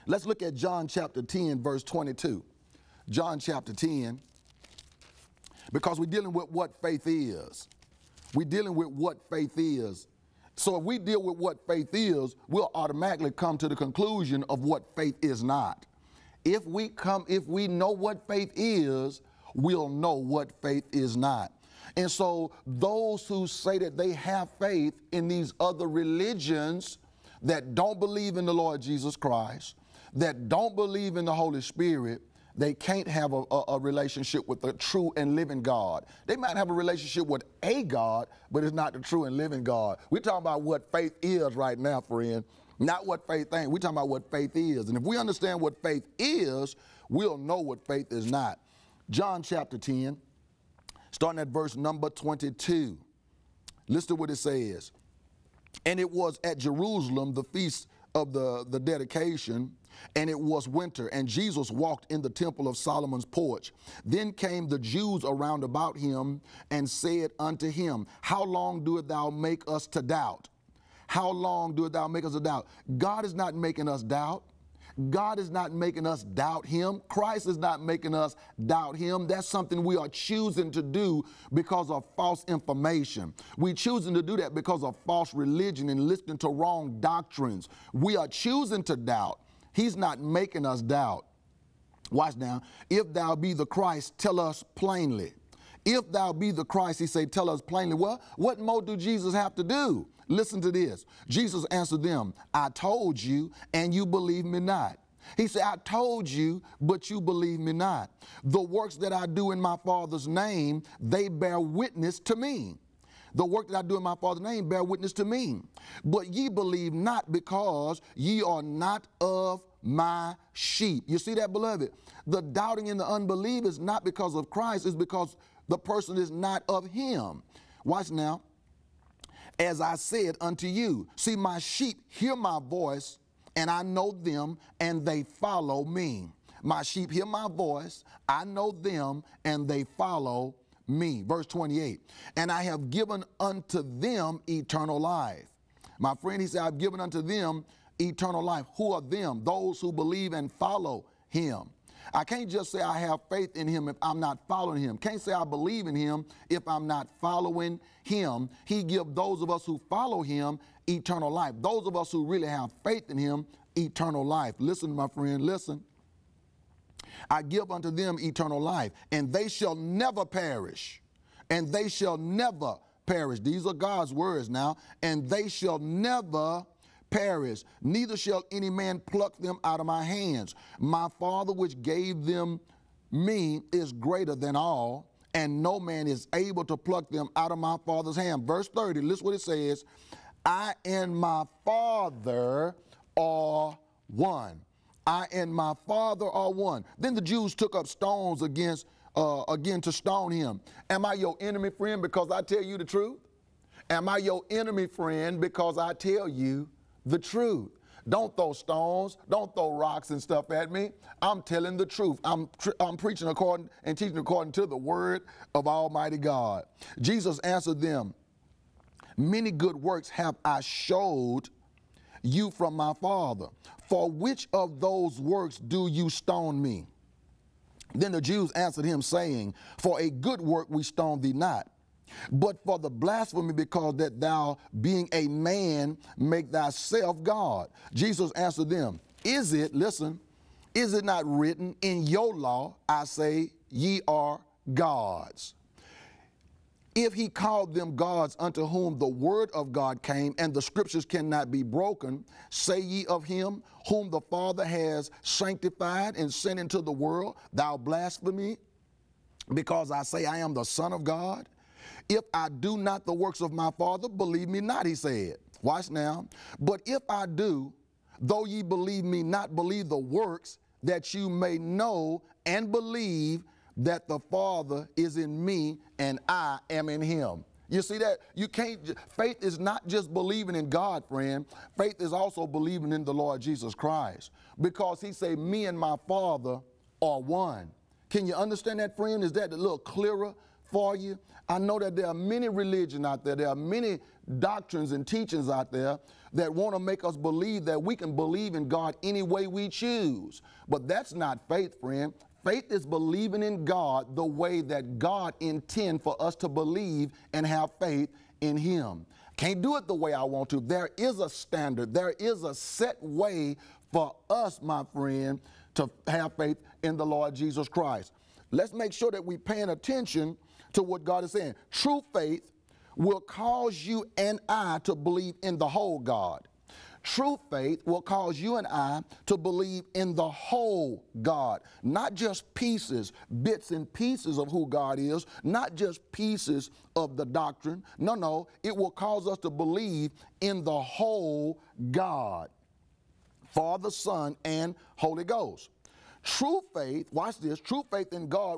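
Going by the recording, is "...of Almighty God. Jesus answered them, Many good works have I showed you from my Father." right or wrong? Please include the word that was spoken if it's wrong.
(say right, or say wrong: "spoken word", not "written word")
right.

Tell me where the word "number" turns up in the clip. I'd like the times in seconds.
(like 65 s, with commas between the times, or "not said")
51 s.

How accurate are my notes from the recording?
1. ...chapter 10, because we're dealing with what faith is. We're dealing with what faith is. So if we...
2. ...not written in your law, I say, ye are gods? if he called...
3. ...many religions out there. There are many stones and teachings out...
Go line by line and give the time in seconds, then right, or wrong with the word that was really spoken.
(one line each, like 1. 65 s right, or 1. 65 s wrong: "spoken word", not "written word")
1. 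3 s right
2. 241 s right
3. 292 s wrong: "doctrines", not "stones".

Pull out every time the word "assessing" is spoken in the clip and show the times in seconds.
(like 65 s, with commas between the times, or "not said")
not said.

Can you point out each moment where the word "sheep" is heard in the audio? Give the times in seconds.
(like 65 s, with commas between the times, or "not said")
120 s, 131 s, 136 s.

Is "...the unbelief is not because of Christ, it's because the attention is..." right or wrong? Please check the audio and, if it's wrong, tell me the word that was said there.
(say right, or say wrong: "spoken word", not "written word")
wrong: "person", not "attention".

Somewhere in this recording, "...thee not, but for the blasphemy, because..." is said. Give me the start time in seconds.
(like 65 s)
231 s.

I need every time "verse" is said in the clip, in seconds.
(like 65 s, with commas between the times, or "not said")
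1 s, 51 s, 141 s, 188 s.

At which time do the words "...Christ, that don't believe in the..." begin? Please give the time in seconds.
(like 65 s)
29 s.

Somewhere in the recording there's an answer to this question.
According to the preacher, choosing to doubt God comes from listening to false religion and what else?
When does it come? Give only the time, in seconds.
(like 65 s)
86 s.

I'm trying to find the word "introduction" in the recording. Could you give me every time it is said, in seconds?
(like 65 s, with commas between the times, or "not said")
not said.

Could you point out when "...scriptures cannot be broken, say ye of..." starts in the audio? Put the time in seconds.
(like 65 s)
250 s.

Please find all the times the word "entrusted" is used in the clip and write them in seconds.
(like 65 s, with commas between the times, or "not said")
not said.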